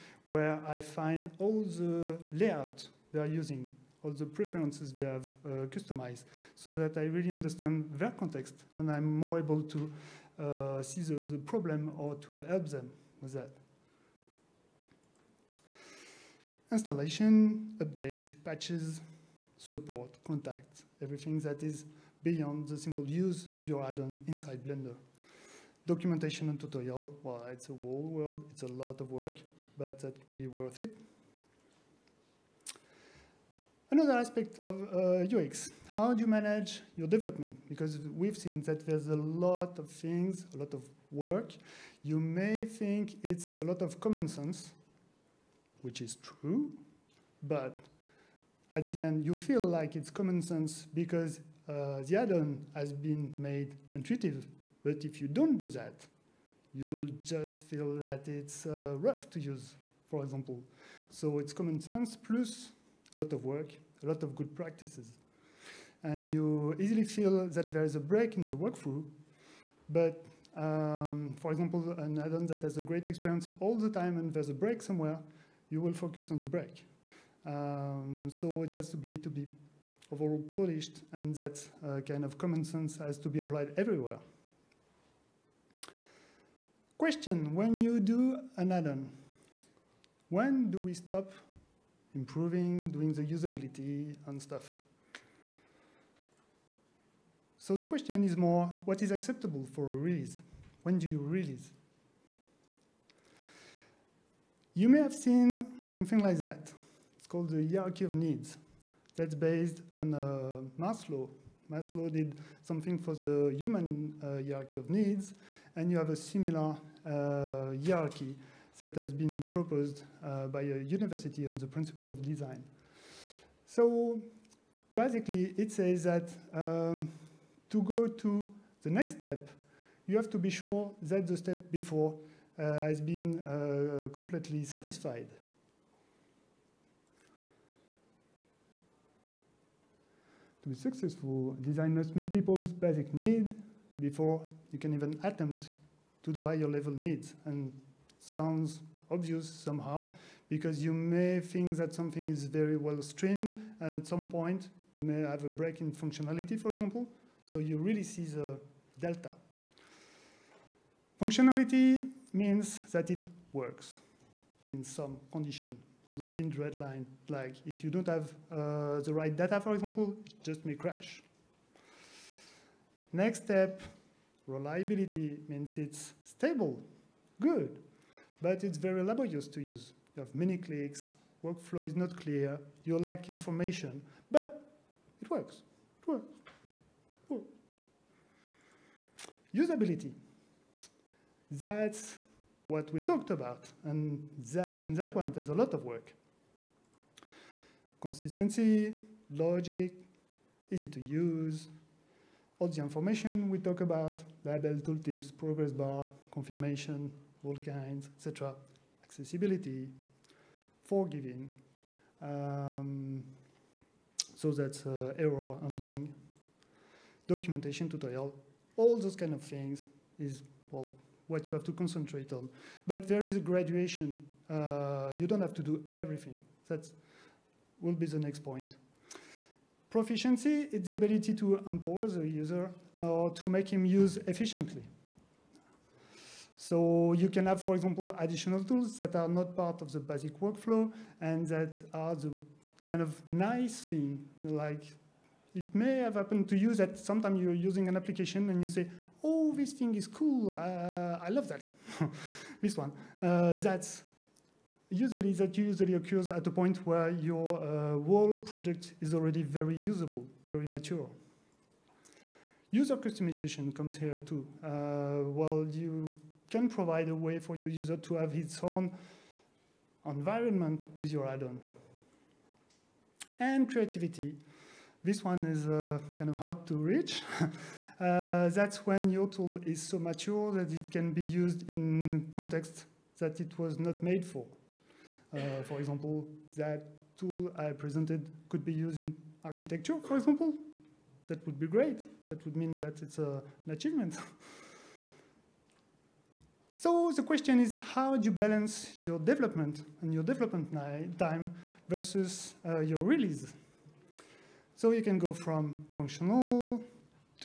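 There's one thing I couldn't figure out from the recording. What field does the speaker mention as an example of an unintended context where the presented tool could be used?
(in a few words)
architecture.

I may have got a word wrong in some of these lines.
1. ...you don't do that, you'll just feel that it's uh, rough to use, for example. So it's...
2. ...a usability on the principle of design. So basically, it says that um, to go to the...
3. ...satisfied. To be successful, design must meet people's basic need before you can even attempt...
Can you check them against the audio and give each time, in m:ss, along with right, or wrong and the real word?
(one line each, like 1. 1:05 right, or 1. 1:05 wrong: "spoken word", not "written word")
1. 0:55 right
2. 2:00 wrong: "university", not "usability"
3. 2:14 right.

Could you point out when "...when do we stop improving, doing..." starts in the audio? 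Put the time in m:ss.
1:30.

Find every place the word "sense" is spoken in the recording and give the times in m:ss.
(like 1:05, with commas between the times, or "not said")
0:44, 0:50, 1:01, 1:22.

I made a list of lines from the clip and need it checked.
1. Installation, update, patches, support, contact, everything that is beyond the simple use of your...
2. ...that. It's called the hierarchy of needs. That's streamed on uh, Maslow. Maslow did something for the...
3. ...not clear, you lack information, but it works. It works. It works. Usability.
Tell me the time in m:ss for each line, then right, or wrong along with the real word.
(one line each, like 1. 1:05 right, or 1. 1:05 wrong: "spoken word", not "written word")
1. 0:16 right
2. 1:46 wrong: "based", not "streamed"
3. 3:01 right.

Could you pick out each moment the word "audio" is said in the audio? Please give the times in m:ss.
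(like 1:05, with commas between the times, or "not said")
not said.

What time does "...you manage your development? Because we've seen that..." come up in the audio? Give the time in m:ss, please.
0:36.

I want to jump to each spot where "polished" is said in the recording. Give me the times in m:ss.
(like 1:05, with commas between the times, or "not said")
1:20.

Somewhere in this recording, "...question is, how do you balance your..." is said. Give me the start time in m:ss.
4:57.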